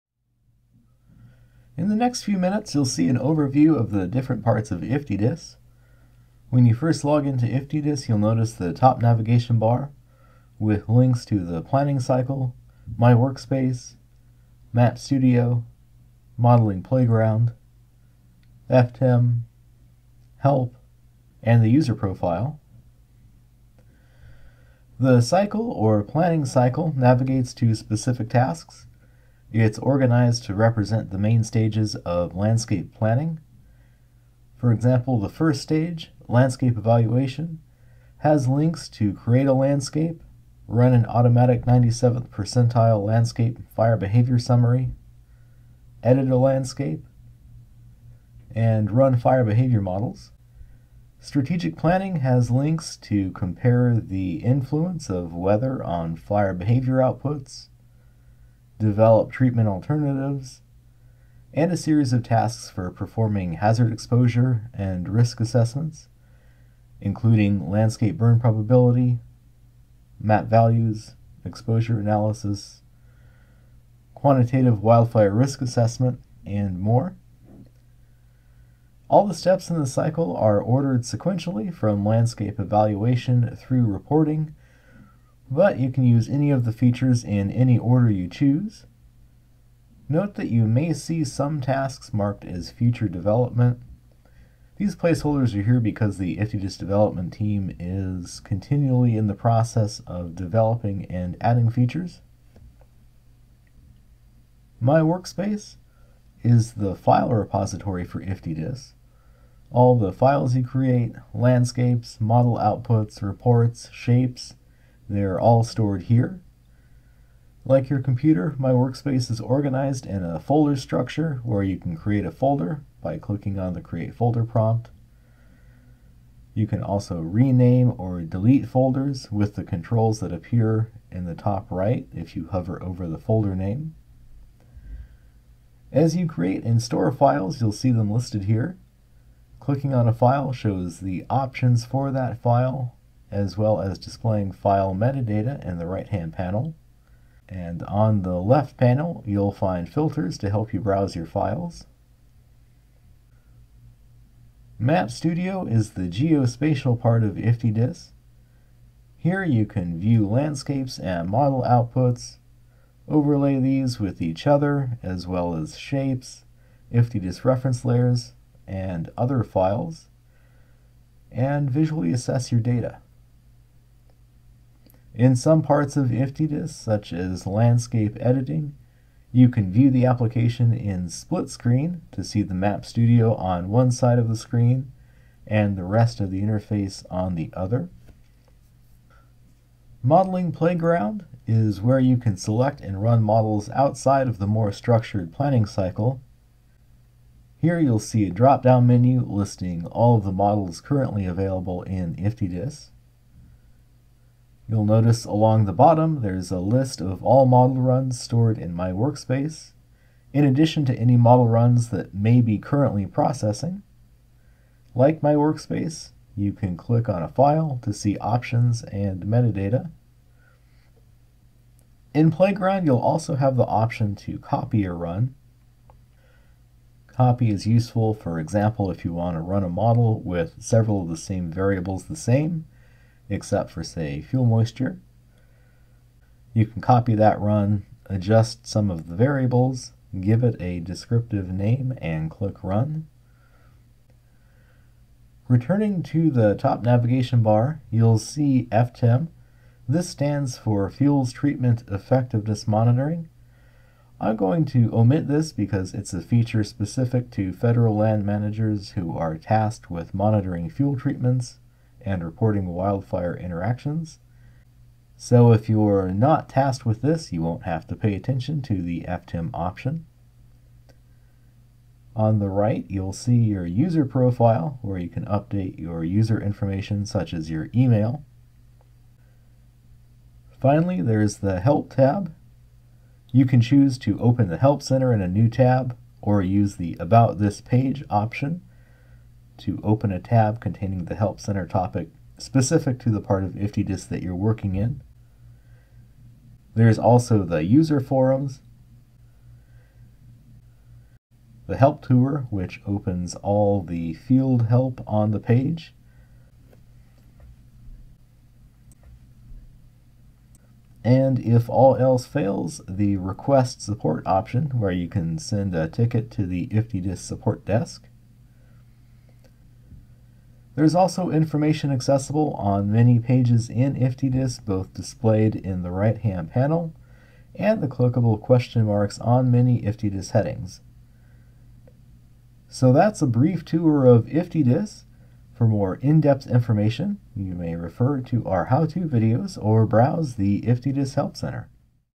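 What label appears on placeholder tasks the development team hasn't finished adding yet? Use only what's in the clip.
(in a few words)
Future development.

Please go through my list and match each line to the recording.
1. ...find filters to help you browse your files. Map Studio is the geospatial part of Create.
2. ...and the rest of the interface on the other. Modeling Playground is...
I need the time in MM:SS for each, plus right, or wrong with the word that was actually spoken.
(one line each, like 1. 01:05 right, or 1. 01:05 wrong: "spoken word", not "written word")
1. 02:29 wrong: "IFTDSS", not "Create"
2. 03:05 right.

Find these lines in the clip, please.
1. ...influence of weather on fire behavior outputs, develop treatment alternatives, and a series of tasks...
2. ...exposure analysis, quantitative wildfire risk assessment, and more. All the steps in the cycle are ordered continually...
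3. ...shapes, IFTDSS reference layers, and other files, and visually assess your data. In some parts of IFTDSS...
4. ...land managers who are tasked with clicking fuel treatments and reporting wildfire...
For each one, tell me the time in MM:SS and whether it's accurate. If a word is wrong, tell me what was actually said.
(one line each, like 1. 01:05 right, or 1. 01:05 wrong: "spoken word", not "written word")
1. 00:54 right
2. 01:11 wrong: "sequentially", not "continually"
3. 02:45 right
4. 04:17 wrong: "monitoring", not "clicking".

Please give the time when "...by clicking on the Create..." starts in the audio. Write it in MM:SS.
02:03.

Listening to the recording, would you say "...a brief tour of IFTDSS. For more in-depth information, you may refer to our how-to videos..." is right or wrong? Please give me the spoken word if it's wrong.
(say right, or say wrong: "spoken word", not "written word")
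right.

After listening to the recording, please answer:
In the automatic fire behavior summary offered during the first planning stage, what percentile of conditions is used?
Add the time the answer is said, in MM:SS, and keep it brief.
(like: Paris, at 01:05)
97th percentile, at 00:41.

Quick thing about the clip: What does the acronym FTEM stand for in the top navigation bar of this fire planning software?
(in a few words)
Fuels Treatment Effectiveness Monitoring.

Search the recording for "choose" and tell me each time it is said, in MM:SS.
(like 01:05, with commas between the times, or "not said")
01:28, 04:43.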